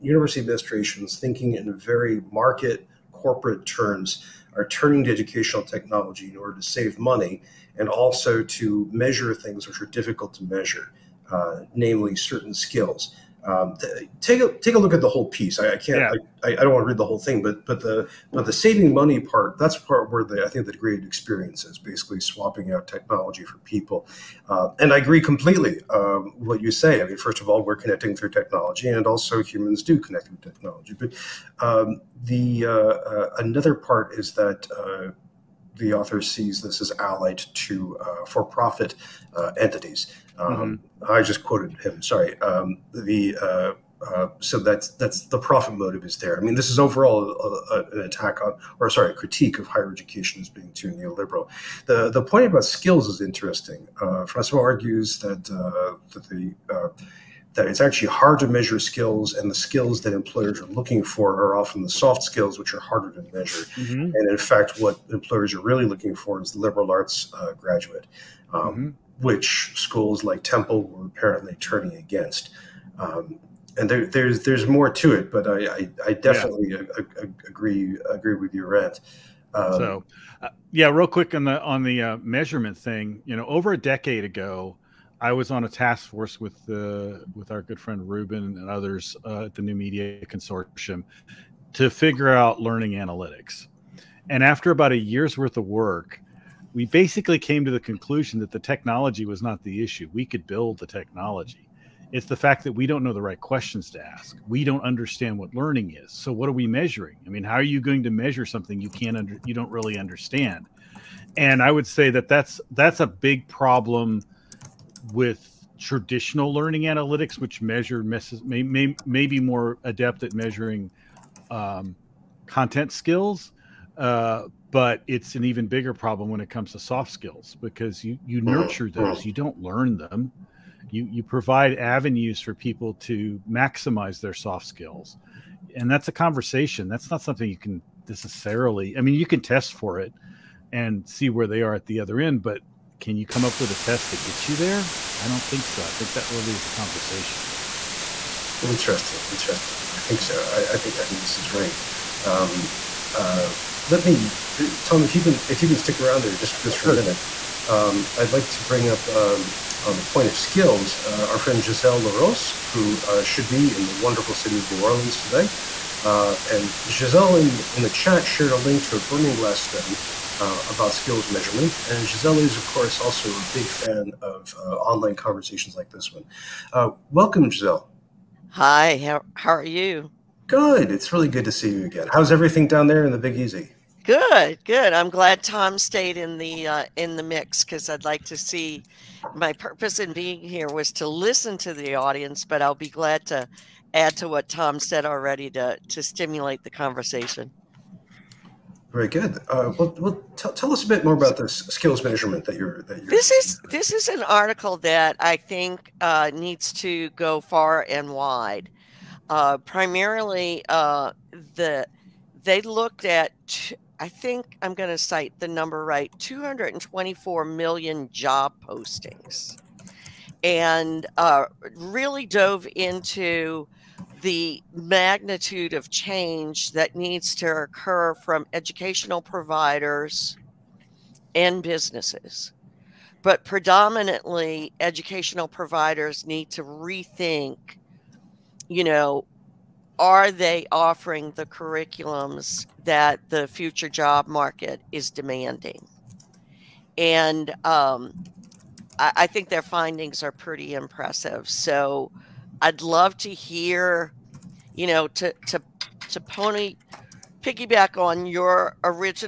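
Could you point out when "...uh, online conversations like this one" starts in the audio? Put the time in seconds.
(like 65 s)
174 s.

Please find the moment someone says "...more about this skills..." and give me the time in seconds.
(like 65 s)
201 s.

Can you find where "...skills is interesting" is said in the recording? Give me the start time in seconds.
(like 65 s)
52 s.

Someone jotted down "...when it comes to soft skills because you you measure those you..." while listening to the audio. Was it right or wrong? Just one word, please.
wrong.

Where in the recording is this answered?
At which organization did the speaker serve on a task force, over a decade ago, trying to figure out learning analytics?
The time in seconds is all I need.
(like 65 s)
89 s.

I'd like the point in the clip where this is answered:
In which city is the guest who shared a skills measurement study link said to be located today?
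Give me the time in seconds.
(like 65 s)
164 s.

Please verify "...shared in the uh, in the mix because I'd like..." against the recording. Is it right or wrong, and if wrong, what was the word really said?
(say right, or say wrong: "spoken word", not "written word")
wrong: "stayed", not "shared".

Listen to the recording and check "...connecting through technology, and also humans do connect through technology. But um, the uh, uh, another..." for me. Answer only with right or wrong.
right.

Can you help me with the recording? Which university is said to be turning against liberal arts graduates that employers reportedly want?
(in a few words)
Temple.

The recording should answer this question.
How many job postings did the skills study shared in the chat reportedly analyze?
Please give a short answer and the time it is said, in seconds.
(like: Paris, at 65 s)
224 million, at 216 s.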